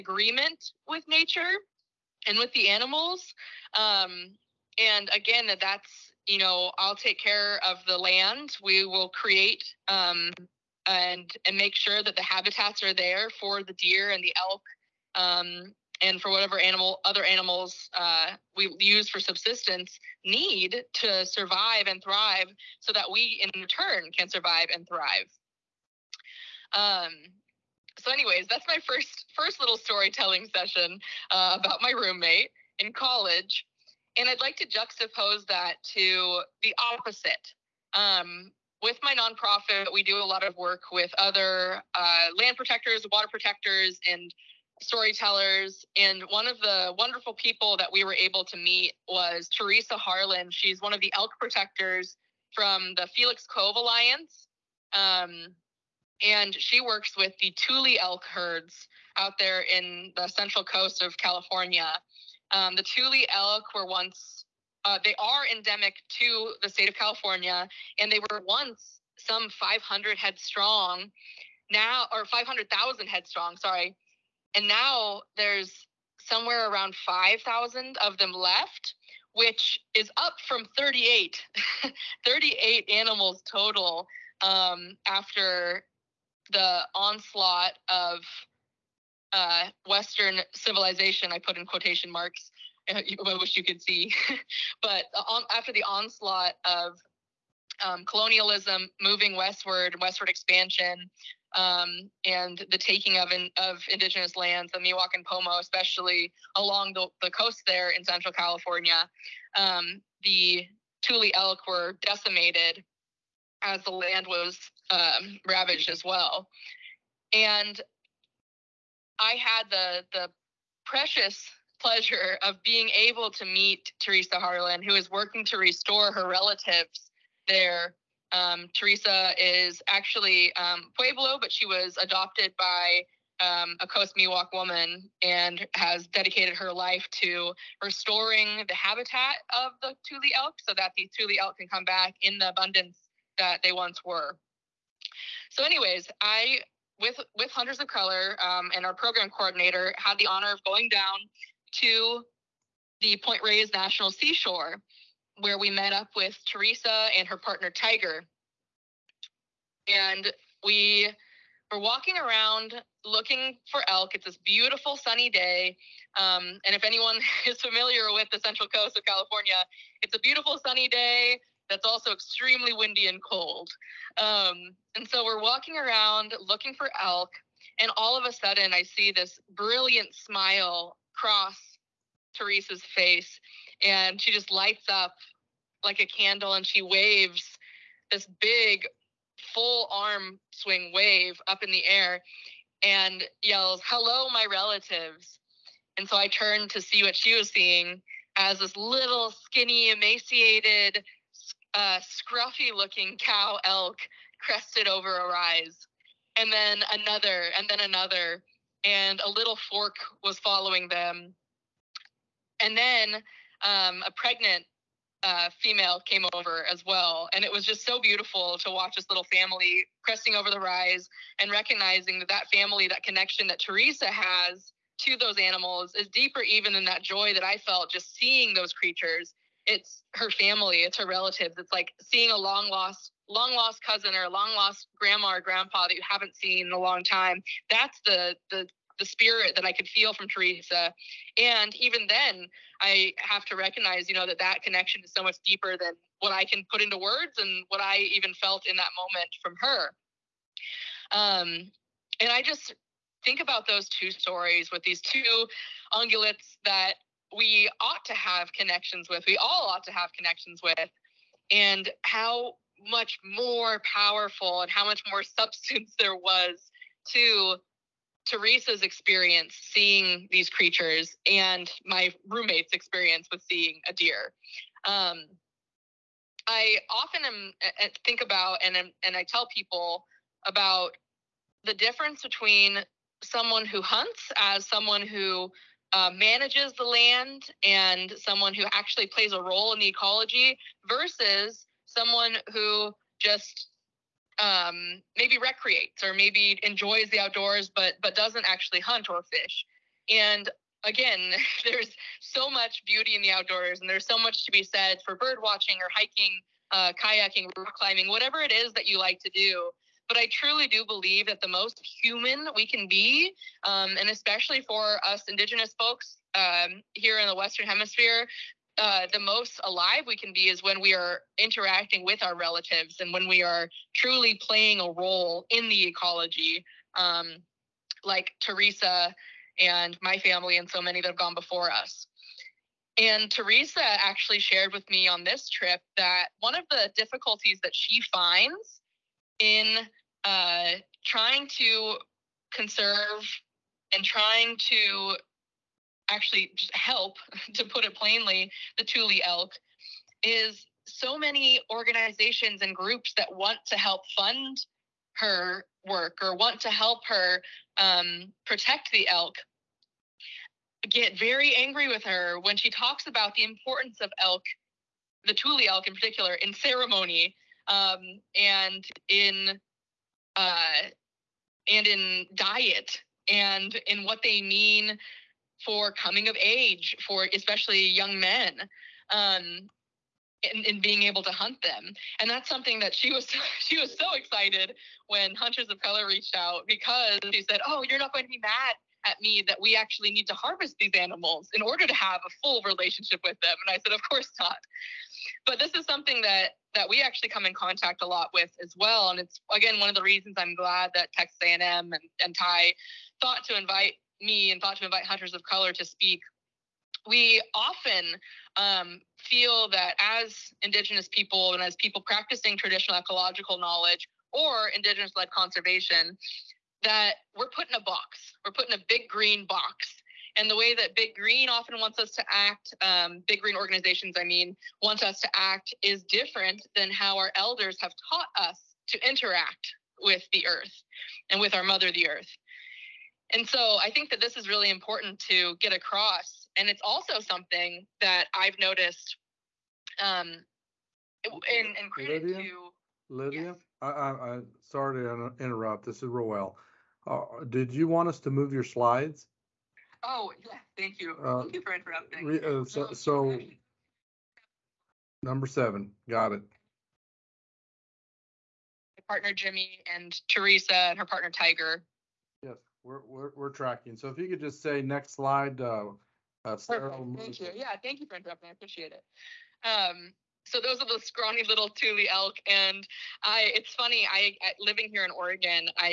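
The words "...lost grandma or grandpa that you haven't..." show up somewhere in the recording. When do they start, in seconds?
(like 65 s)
234 s.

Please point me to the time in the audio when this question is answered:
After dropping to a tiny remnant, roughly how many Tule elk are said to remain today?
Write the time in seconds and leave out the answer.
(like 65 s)
77 s.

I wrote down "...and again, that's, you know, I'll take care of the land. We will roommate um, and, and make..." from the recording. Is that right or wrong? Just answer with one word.
wrong.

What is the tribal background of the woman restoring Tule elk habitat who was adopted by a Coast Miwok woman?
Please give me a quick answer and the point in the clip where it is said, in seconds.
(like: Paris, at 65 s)
Pueblo, at 130 s.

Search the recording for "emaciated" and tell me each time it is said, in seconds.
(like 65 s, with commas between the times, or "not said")
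199 s.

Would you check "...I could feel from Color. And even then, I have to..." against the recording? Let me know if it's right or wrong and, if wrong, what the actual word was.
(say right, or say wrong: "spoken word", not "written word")
wrong: "Teresa", not "Color".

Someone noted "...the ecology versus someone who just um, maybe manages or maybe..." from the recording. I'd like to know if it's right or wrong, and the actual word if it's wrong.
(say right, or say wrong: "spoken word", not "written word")
wrong: "recreates", not "manages".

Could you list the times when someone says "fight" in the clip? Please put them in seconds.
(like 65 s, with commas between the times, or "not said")
not said.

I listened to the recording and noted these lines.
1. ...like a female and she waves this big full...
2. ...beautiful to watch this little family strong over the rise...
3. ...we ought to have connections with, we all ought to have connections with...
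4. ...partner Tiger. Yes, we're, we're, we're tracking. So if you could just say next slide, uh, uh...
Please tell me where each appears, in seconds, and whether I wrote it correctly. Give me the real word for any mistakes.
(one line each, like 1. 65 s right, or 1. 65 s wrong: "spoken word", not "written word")
1. 185 s wrong: "candle", not "female"
2. 217 s wrong: "cresting", not "strong"
3. 257 s right
4. 461 s right.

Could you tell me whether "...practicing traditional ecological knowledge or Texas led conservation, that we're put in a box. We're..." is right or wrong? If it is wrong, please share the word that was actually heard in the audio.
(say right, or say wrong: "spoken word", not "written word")
wrong: "Indigenous", not "Texas".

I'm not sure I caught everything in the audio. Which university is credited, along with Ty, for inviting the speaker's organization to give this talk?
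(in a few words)
Texas A&M.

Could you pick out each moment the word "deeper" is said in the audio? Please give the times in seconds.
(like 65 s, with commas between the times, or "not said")
226 s, 245 s.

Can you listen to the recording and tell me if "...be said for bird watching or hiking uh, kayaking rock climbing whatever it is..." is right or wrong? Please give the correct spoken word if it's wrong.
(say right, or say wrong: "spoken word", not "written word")
right.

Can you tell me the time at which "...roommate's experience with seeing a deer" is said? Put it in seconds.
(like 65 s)
272 s.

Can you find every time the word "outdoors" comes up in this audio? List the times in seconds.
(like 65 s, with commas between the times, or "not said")
297 s, 303 s.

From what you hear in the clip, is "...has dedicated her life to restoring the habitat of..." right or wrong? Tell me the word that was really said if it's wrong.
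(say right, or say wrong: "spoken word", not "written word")
right.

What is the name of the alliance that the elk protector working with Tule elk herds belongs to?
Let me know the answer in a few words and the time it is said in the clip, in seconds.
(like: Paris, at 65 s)
Felix Cove Alliance, at 53 s.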